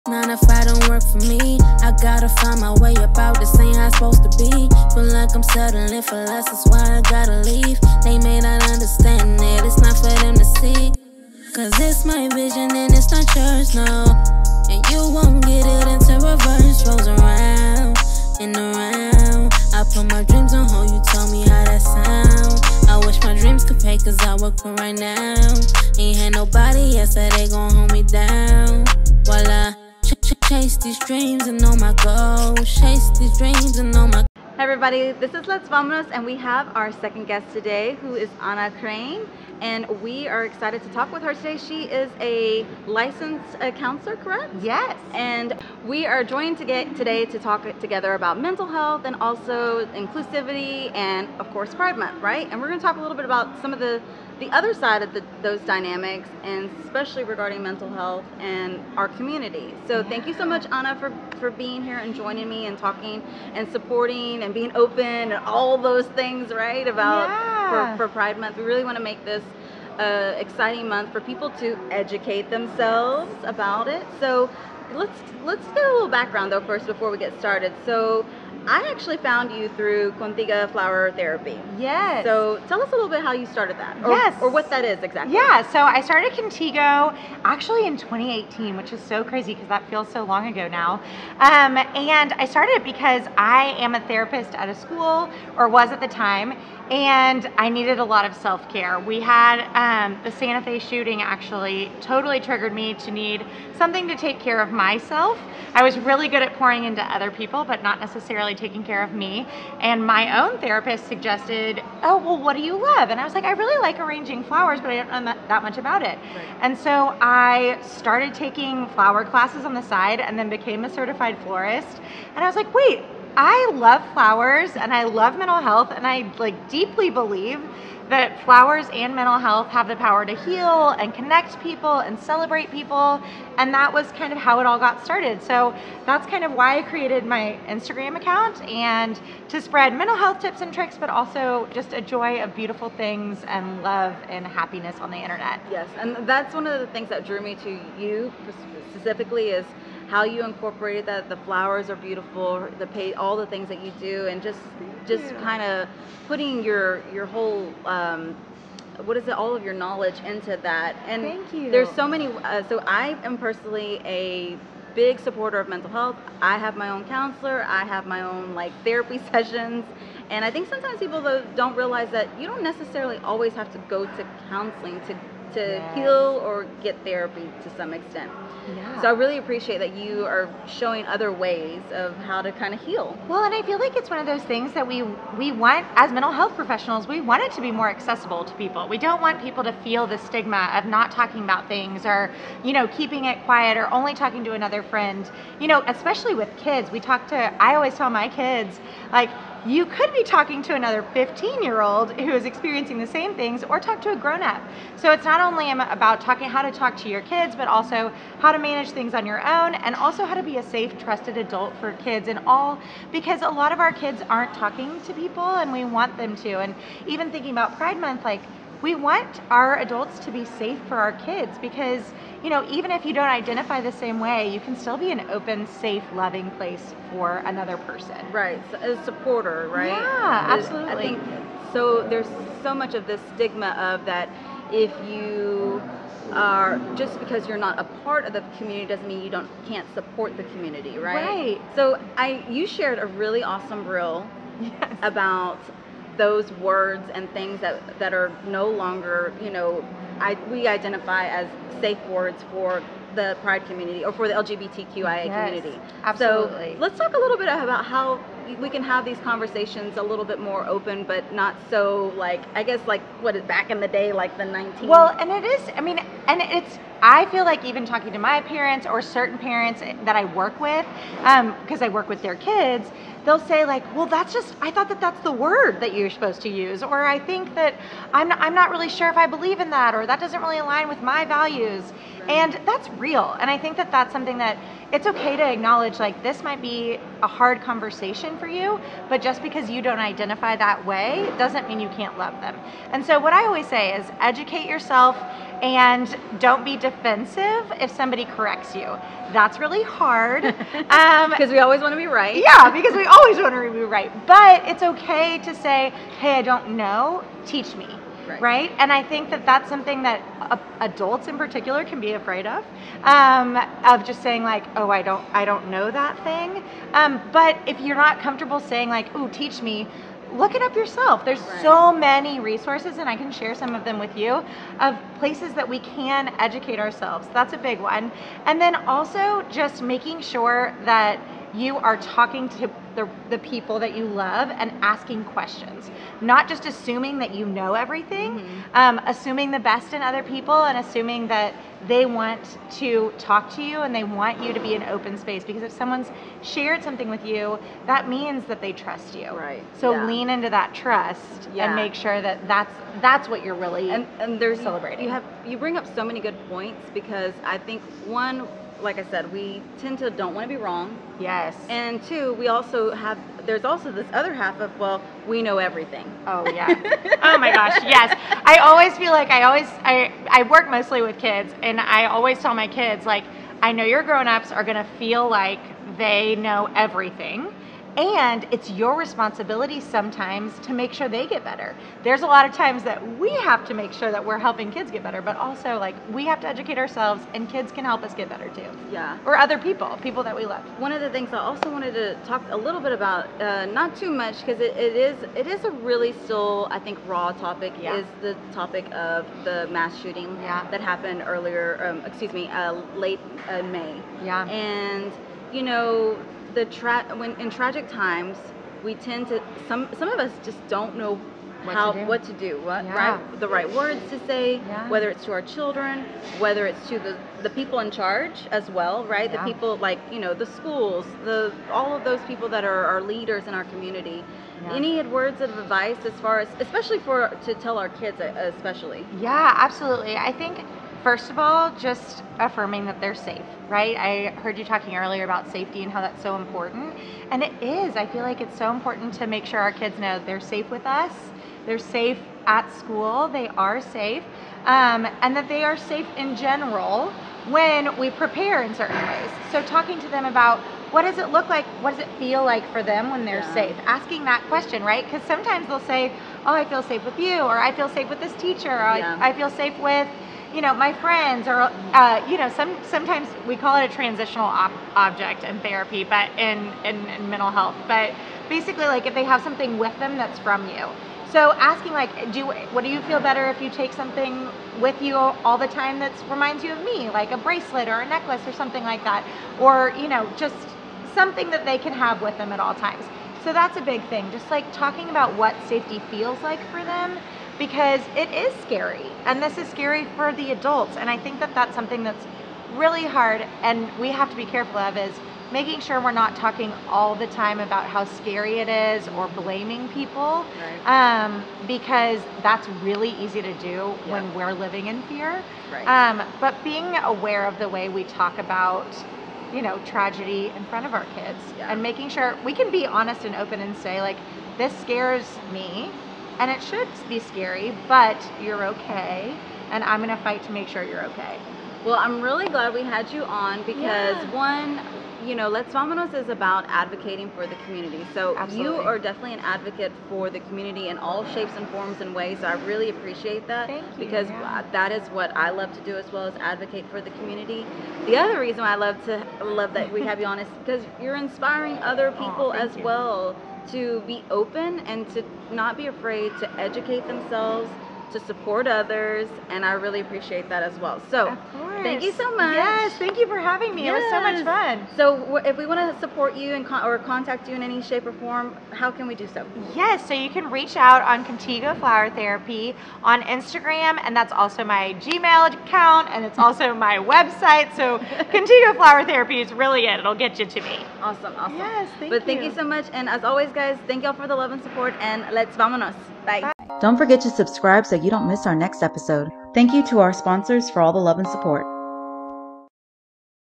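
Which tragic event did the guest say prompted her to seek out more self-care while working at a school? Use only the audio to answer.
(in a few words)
Santa Fe shooting.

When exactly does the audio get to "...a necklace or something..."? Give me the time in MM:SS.
07:58.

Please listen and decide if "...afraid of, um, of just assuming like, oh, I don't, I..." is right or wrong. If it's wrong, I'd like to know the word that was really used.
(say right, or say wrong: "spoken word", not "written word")
wrong: "saying", not "assuming".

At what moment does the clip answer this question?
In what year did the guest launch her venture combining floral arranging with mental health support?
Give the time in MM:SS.
01:27.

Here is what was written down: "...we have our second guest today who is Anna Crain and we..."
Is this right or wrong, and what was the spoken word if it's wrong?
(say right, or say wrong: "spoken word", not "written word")
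right.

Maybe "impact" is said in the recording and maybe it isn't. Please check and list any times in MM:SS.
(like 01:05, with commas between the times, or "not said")
not said.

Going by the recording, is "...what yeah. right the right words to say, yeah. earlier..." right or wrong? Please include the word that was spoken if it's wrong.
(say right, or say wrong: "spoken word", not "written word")
wrong: "whether", not "earlier".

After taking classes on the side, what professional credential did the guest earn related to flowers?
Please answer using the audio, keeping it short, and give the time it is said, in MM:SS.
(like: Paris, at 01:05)
certified florist, at 02:00.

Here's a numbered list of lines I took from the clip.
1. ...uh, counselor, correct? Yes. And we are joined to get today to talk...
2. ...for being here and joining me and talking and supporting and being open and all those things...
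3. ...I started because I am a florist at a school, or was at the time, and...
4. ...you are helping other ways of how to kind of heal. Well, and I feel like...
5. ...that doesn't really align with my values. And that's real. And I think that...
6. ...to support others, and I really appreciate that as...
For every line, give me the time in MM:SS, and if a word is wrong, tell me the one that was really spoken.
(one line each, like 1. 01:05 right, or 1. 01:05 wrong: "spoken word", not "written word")
1. 00:43 right
2. 01:01 right
3. 01:32 wrong: "therapist", not "florist"
4. 02:59 wrong: "showing", not "helping"
5. 04:40 right
6. 09:08 right.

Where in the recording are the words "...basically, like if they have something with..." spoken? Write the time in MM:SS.
07:48.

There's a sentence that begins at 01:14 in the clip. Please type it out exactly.
So let's let's get a little background though first before we get started.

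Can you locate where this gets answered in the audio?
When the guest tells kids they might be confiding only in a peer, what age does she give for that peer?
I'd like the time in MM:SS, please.
03:21.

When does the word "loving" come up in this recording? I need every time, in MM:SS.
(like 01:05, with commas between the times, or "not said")
03:46.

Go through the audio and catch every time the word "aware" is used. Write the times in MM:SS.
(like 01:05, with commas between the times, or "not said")
08:27.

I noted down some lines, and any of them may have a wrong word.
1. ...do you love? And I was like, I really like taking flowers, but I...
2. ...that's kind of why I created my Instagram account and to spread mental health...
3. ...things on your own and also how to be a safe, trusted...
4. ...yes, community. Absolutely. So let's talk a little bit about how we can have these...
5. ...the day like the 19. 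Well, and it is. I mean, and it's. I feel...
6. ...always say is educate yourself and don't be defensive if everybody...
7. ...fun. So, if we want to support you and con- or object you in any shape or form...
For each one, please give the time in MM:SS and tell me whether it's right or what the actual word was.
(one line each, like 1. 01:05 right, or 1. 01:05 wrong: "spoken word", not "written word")
1. 01:52 wrong: "arranging", not "taking"
2. 02:16 right
3. 03:28 right
4. 04:15 right
5. 04:23 right
6. 04:53 wrong: "somebody", not "everybody"
7. 09:14 wrong: "contact", not "object".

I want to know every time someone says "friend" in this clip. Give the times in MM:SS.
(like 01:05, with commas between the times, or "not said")
03:14, 07:40.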